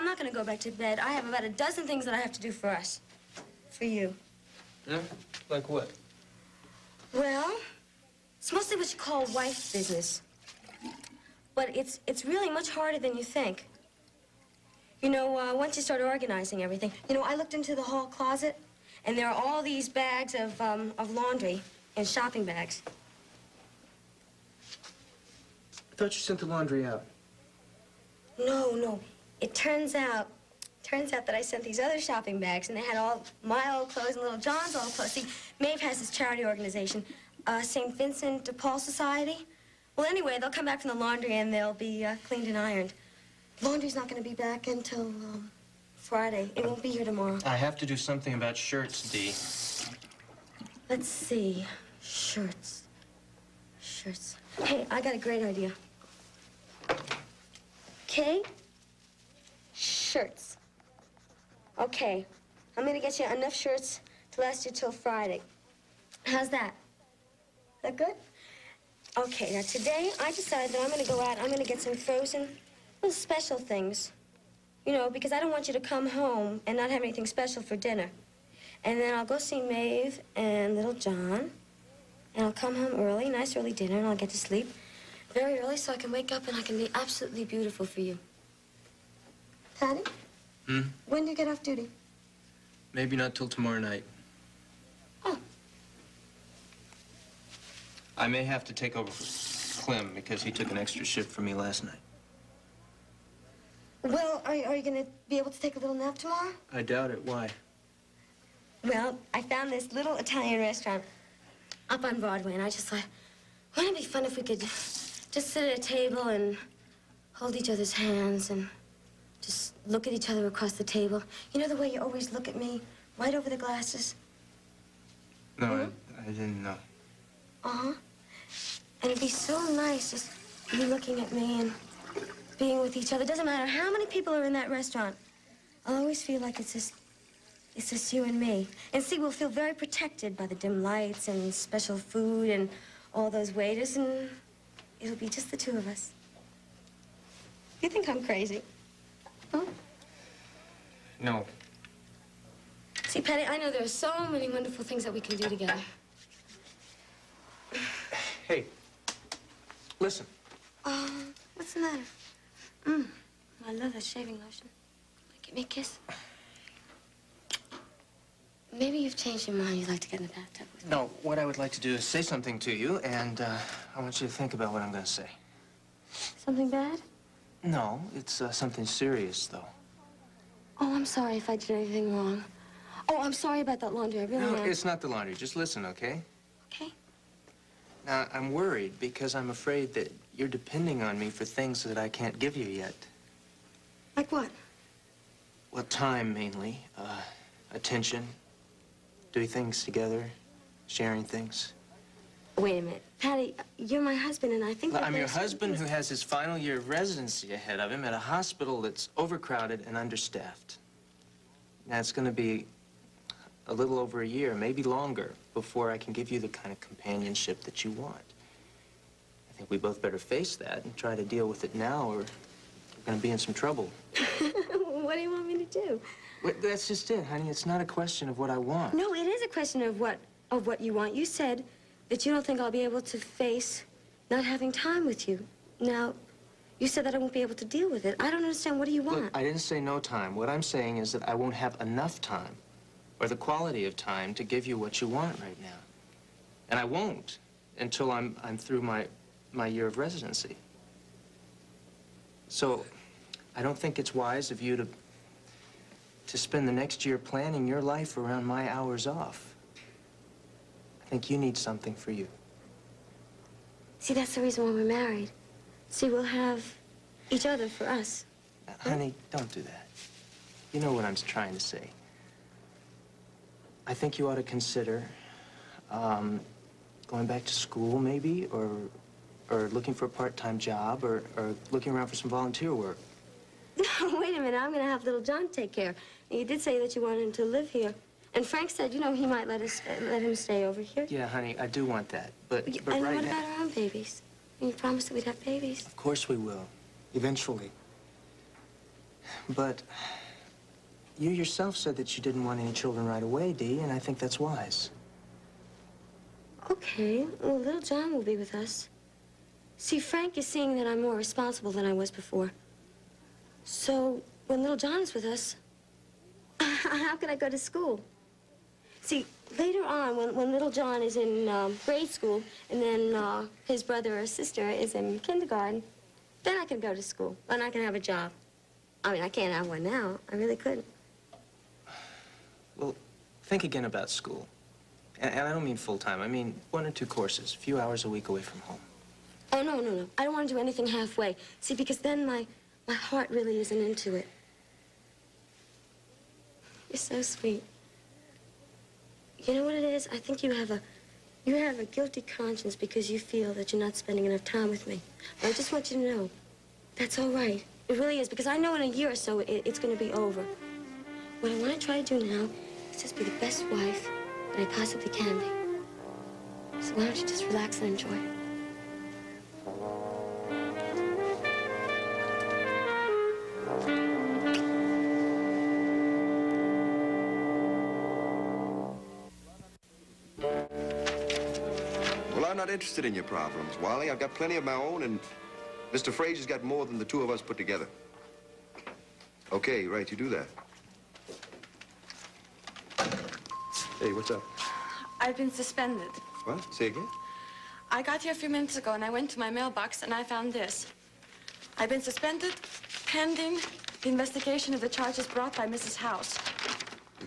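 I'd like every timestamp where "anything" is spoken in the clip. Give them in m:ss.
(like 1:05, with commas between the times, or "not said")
1:17, 3:01, 5:40.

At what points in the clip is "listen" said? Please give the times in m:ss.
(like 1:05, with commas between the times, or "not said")
2:39, 3:05.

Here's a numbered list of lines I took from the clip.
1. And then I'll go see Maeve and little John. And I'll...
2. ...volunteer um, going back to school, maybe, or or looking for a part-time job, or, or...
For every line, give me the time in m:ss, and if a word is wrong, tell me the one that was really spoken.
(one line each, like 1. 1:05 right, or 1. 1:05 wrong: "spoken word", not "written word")
1. 1:18 right
2. 4:34 wrong: "consider", not "volunteer".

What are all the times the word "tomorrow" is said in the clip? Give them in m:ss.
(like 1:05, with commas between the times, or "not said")
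0:47, 1:33, 1:46.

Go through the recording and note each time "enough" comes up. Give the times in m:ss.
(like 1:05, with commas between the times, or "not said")
1:03, 4:01, 5:54.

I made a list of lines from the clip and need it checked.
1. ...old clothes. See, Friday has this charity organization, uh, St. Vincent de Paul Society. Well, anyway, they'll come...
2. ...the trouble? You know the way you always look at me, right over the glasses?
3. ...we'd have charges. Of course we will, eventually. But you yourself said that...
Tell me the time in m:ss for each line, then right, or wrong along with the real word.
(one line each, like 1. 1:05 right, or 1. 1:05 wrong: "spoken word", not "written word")
1. 0:34 wrong: "Maeve", not "Friday"
2. 2:00 wrong: "table", not "trouble"
3. 4:55 wrong: "babies", not "charges".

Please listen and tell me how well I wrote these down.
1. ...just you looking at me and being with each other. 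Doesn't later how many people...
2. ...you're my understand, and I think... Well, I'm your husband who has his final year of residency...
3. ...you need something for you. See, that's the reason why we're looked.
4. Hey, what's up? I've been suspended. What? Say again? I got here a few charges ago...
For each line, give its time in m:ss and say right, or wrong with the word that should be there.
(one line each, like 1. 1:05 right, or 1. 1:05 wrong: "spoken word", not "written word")
1. 2:10 wrong: "matter", not "later"
2. 3:23 wrong: "husband", not "understand"
3. 4:21 wrong: "married", not "looked"
4. 6:33 wrong: "minutes", not "charges".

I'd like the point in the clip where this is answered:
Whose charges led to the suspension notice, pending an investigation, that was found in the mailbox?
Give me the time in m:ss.
6:45.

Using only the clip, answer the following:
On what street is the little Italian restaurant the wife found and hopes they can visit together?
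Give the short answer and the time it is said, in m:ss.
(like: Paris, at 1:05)
Broadway, at 1:52.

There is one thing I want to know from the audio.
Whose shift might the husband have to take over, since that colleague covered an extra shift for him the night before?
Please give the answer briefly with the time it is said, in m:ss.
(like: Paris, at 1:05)
Clem, at 1:39.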